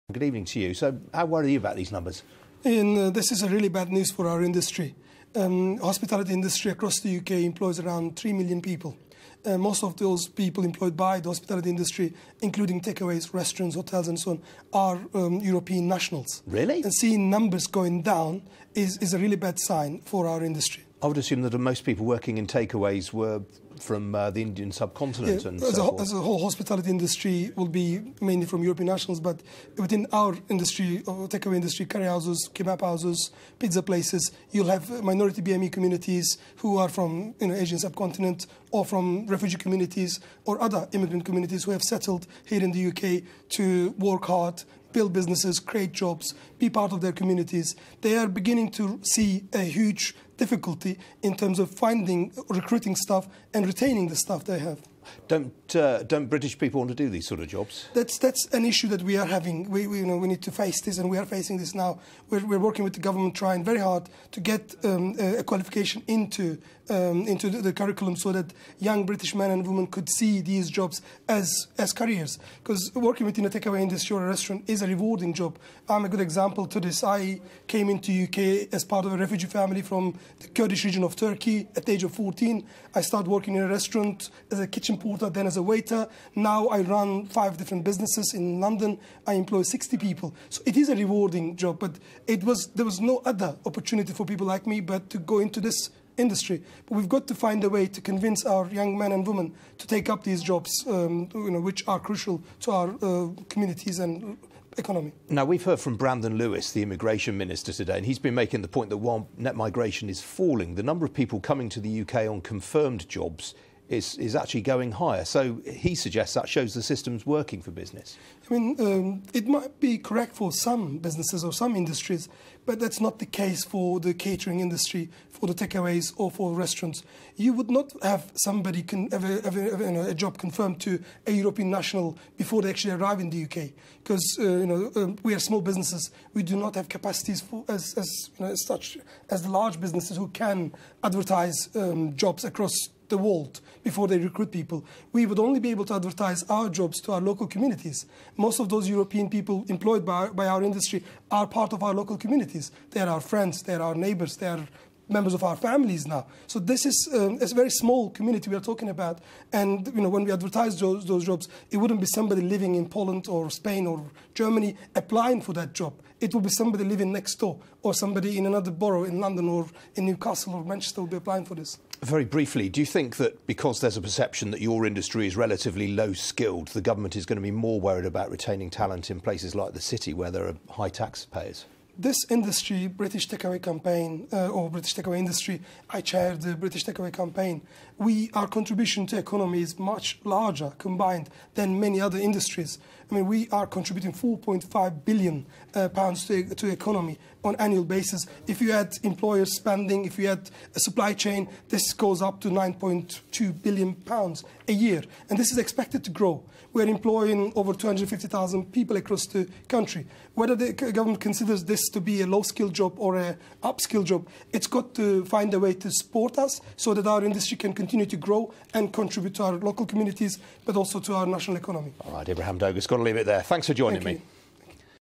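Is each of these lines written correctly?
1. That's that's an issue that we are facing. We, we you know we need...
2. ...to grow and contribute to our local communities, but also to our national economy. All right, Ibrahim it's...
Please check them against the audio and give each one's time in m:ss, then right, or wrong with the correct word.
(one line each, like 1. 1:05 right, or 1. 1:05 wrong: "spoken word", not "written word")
1. 0:57 wrong: "having", not "facing"
2. 3:38 right.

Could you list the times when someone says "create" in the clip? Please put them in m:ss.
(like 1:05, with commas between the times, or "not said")
0:45.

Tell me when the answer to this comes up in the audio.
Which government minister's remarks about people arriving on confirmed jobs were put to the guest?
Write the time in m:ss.
1:45.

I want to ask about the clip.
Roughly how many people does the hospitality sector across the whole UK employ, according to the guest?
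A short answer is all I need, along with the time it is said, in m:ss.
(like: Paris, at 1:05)
3 million, at 0:08.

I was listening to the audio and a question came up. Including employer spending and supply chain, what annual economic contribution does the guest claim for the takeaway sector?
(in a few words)
£9.2 billion.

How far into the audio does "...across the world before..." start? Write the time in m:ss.
2:22.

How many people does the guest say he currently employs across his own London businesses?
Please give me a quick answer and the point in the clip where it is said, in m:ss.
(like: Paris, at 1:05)
60, at 1:29.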